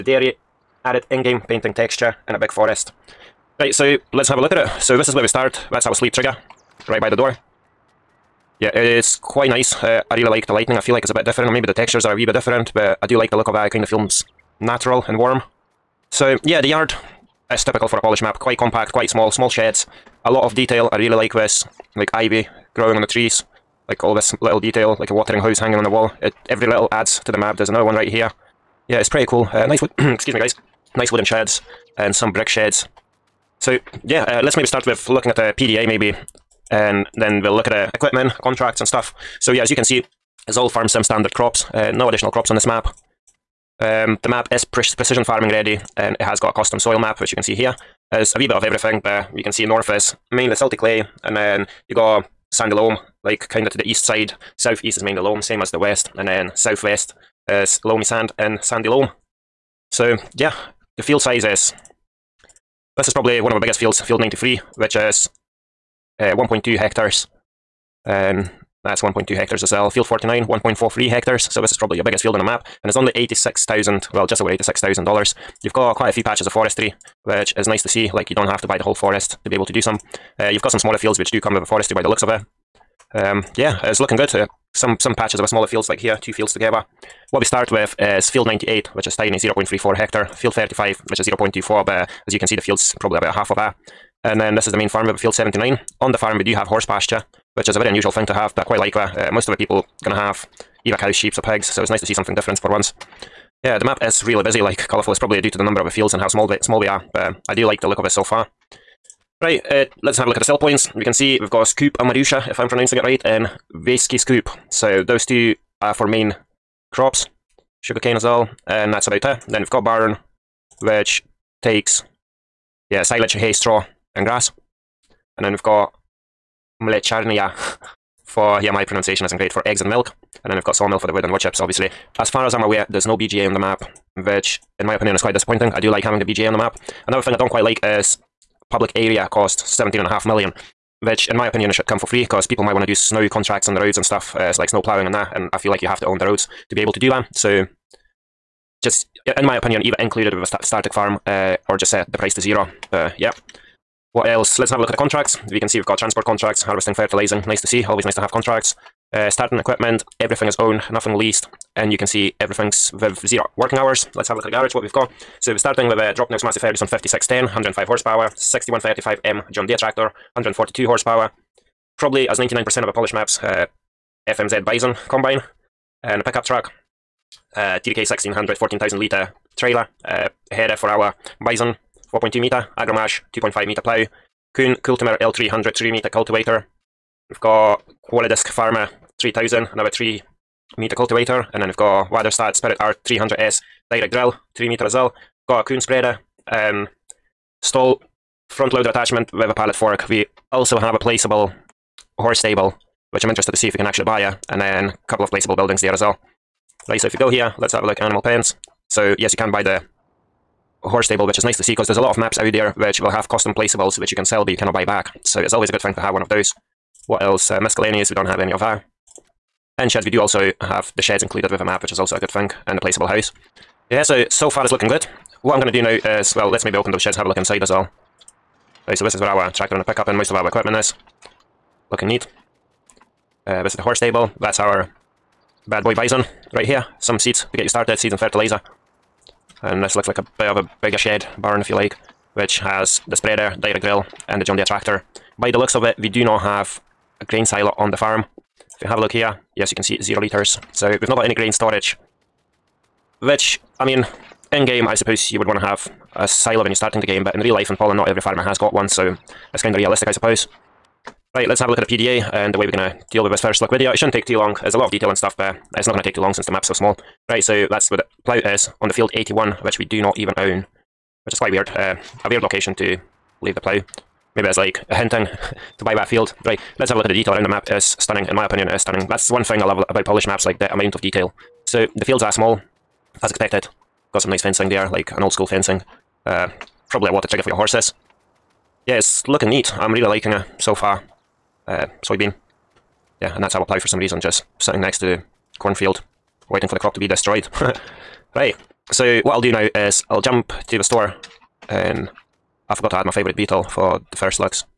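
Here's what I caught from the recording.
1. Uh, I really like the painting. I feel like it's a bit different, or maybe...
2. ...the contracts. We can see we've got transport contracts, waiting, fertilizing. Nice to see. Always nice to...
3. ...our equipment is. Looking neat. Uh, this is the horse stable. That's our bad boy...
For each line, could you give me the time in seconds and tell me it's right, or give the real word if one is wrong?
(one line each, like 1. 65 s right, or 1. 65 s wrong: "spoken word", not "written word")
1. 9 s wrong: "lighting", not "painting"
2. 154 s wrong: "harvesting", not "waiting"
3. 230 s right.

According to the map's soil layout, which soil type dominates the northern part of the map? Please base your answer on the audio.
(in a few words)
salty clay.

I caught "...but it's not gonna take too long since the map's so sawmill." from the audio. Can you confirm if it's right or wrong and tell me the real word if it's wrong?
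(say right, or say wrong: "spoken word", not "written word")
wrong: "small", not "sawmill".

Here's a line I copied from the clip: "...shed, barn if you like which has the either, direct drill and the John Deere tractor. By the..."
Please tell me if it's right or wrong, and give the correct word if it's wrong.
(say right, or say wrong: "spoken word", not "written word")
wrong: "spreader", not "either".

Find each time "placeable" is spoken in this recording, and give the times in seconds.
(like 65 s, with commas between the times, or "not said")
200 s, 205 s, 213 s, 222 s.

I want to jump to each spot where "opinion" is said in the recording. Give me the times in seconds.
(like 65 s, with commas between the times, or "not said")
134 s, 141 s, 149 s, 278 s.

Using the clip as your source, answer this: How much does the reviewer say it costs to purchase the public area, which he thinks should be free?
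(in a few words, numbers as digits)
17.5 million.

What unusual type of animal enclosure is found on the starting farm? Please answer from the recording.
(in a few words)
horse pasture.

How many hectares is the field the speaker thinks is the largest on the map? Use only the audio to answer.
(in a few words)
1.43 hectares.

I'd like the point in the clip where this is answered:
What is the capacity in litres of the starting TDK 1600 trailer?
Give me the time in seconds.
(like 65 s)
178 s.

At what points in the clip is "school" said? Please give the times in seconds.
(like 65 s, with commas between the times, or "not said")
285 s.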